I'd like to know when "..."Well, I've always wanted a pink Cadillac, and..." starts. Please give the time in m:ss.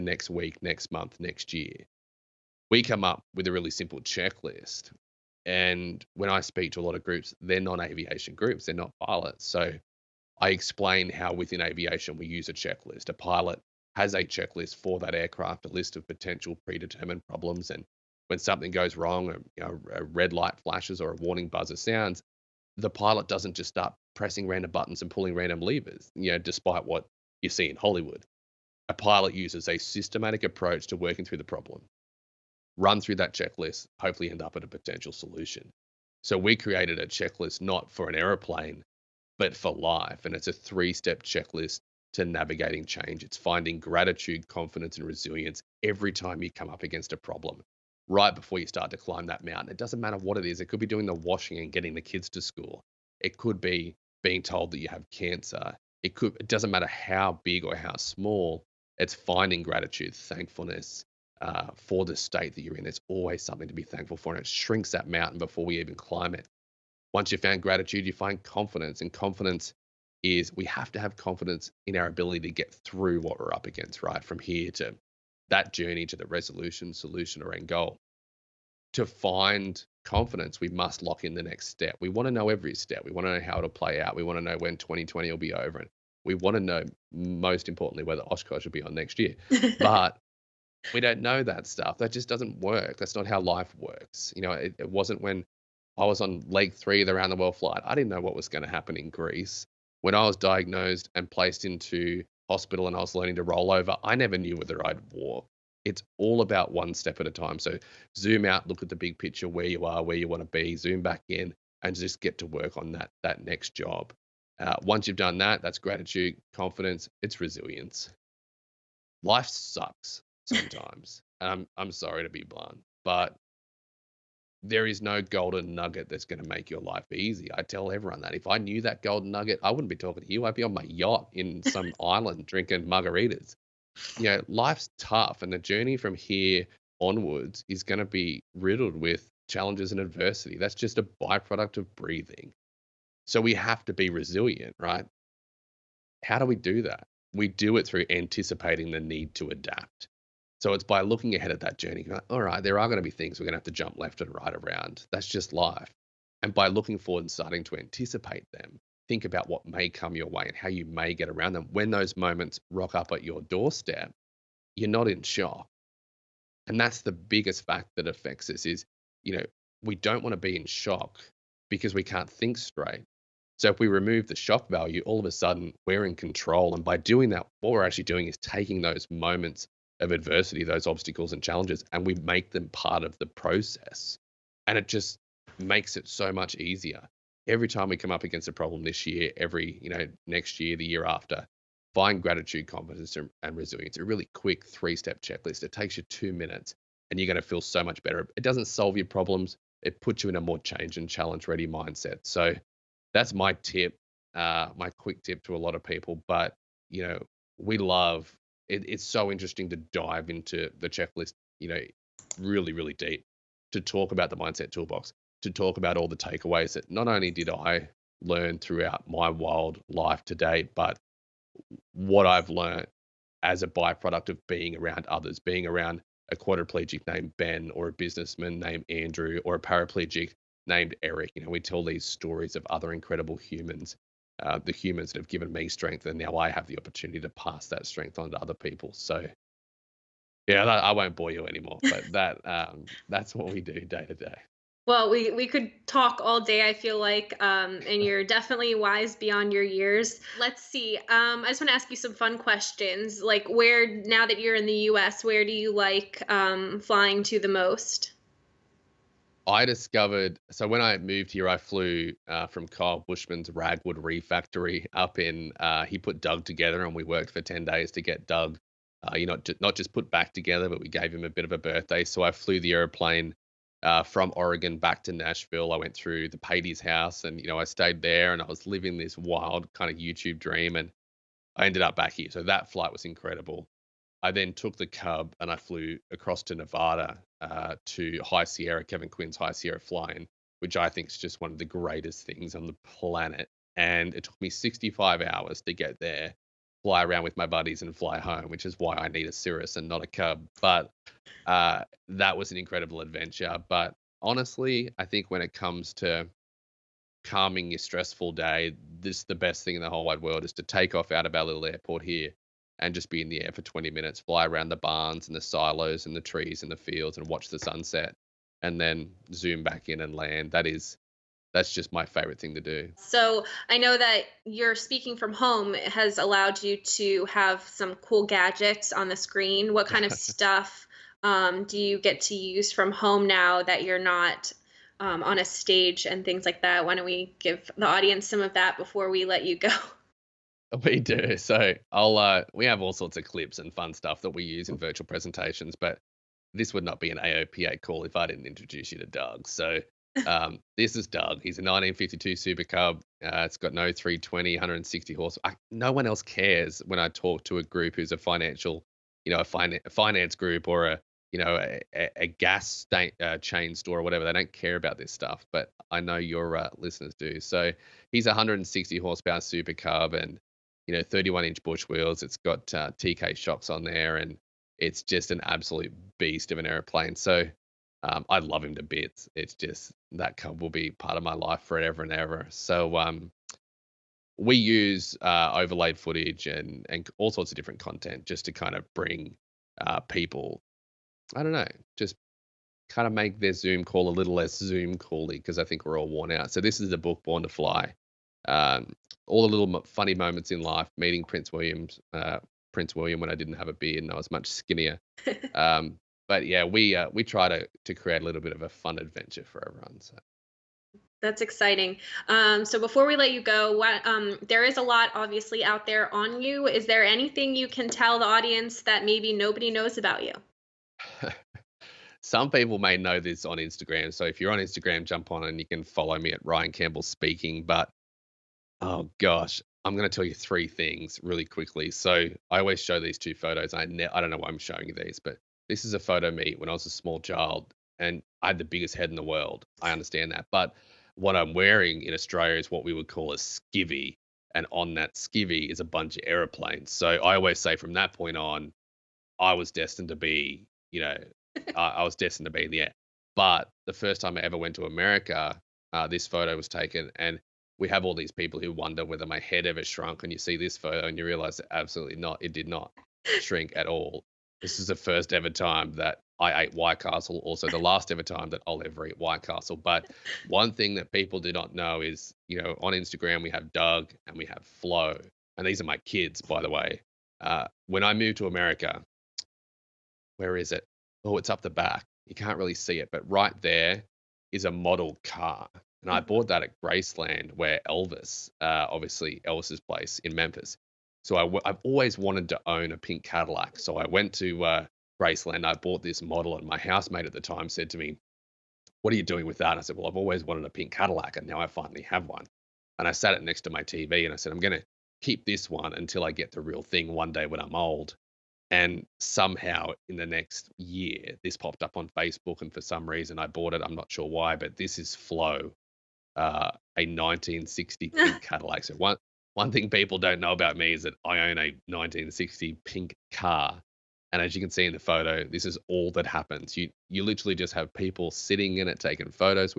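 8:19.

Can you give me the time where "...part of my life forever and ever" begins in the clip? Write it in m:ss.
6:20.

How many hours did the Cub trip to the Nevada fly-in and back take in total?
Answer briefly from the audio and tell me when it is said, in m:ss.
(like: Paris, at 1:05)
65 hours, at 4:54.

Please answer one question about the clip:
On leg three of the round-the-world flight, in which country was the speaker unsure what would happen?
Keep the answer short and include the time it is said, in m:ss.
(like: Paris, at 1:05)
Greece, at 1:39.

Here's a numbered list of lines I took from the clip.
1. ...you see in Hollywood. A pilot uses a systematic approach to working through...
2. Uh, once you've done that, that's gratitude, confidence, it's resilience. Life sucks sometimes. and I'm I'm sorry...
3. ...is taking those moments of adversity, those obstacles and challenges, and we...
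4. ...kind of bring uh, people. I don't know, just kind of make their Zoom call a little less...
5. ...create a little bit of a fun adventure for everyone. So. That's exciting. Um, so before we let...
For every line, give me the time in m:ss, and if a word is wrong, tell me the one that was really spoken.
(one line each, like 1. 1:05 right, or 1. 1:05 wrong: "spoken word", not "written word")
1. 0:27 right
2. 1:54 right
3. 2:58 right
4. 6:28 right
5. 6:47 right.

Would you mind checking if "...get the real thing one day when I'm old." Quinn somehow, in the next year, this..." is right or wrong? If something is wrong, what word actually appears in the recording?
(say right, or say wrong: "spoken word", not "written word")
wrong: "And", not "Quinn".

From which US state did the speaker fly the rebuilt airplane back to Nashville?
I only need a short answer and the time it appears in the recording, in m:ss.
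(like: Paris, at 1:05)
Oregon, at 4:34.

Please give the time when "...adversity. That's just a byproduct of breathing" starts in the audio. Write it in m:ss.
2:20.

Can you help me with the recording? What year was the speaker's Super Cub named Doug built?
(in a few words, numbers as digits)
1952.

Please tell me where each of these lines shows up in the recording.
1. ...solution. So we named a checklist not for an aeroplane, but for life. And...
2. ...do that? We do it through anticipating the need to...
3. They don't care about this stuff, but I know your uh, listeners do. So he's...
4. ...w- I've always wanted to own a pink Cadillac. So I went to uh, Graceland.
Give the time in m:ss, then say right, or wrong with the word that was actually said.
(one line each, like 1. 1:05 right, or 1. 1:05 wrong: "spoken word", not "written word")
1. 0:35 wrong: "created", not "named"
2. 2:26 right
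3. 6:04 right
4. 8:11 right.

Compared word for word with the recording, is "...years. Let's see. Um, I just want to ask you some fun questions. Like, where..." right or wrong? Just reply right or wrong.
right.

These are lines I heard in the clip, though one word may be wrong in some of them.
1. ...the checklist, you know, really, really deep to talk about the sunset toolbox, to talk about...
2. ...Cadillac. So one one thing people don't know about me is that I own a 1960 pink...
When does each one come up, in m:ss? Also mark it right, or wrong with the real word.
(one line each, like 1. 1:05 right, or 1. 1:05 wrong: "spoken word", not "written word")
1. 3:30 wrong: "mindset", not "sunset"
2. 8:38 right.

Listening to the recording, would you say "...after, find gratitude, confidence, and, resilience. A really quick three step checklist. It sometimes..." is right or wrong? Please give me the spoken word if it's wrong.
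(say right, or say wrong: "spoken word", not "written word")
wrong: "takes", not "sometimes".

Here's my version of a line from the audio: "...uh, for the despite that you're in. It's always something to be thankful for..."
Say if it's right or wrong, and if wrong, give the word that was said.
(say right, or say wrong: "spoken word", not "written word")
wrong: "state", not "despite".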